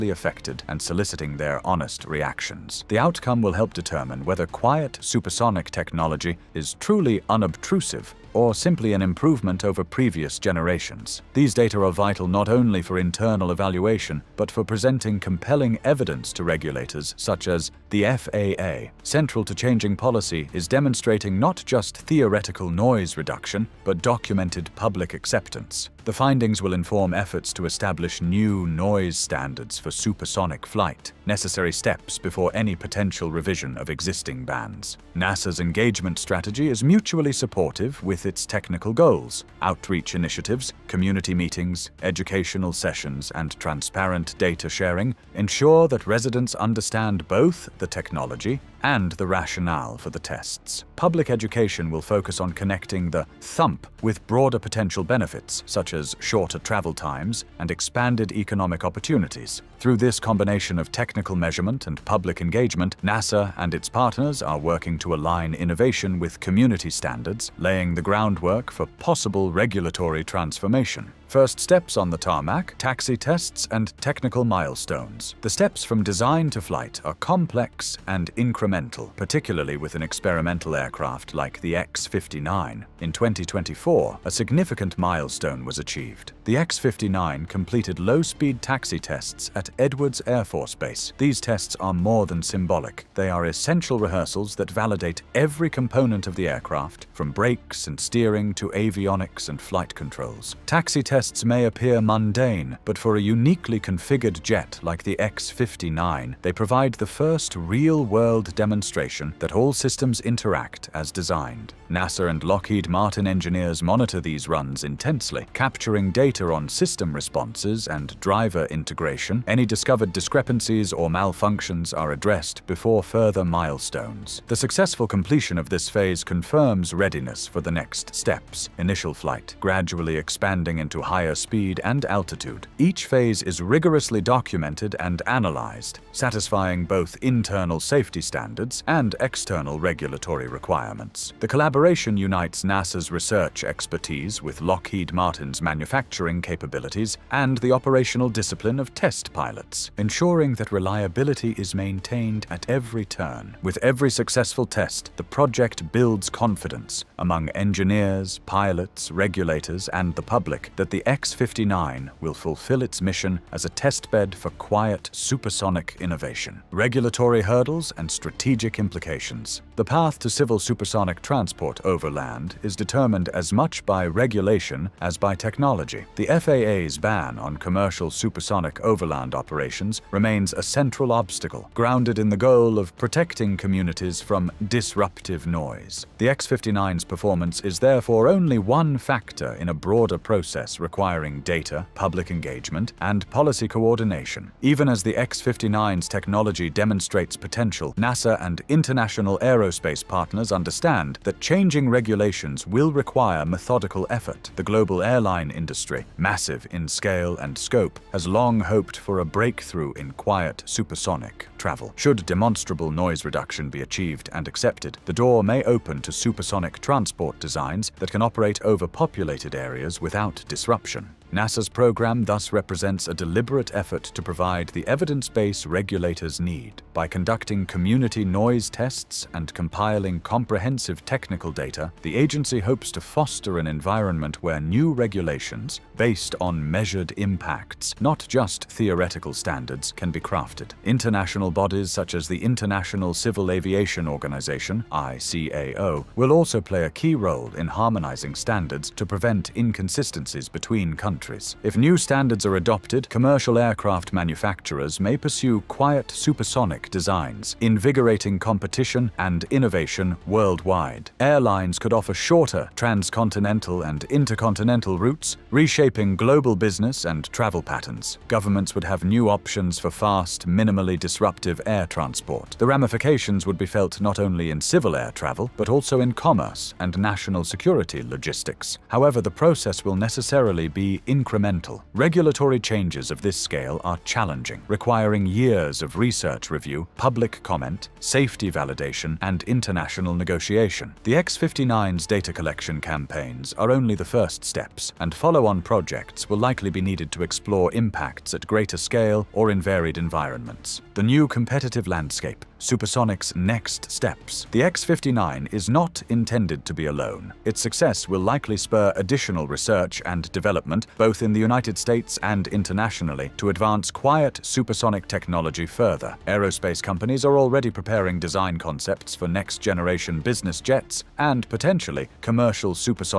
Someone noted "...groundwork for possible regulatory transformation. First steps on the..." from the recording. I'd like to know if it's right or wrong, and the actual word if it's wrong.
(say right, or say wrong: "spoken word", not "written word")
right.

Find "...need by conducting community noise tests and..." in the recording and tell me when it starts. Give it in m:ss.
3:46.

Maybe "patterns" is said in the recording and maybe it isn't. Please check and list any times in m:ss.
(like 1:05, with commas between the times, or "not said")
4:27.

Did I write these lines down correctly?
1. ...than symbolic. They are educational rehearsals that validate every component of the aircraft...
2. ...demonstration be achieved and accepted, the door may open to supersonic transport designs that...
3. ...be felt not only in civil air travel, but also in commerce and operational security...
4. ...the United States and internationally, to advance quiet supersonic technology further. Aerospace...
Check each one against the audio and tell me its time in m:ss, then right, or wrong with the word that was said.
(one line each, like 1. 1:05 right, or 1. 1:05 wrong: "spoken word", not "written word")
1. 1:32 wrong: "essential", not "educational"
2. 3:33 wrong: "reduction", not "demonstration"
3. 4:33 wrong: "national", not "operational"
4. 5:11 right.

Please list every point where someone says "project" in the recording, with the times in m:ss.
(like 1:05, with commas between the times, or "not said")
2:35, 4:55.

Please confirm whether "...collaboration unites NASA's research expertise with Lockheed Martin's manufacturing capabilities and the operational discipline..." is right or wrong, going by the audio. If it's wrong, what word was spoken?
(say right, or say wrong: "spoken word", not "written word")
right.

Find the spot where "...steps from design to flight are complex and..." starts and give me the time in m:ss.
1:15.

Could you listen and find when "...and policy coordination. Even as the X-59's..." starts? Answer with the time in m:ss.
3:13.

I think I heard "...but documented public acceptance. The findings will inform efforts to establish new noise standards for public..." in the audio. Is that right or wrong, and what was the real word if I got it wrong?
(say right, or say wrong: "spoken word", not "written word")
wrong: "supersonic", not "public".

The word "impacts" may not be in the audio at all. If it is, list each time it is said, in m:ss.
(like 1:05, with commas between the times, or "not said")
3:57, 4:57.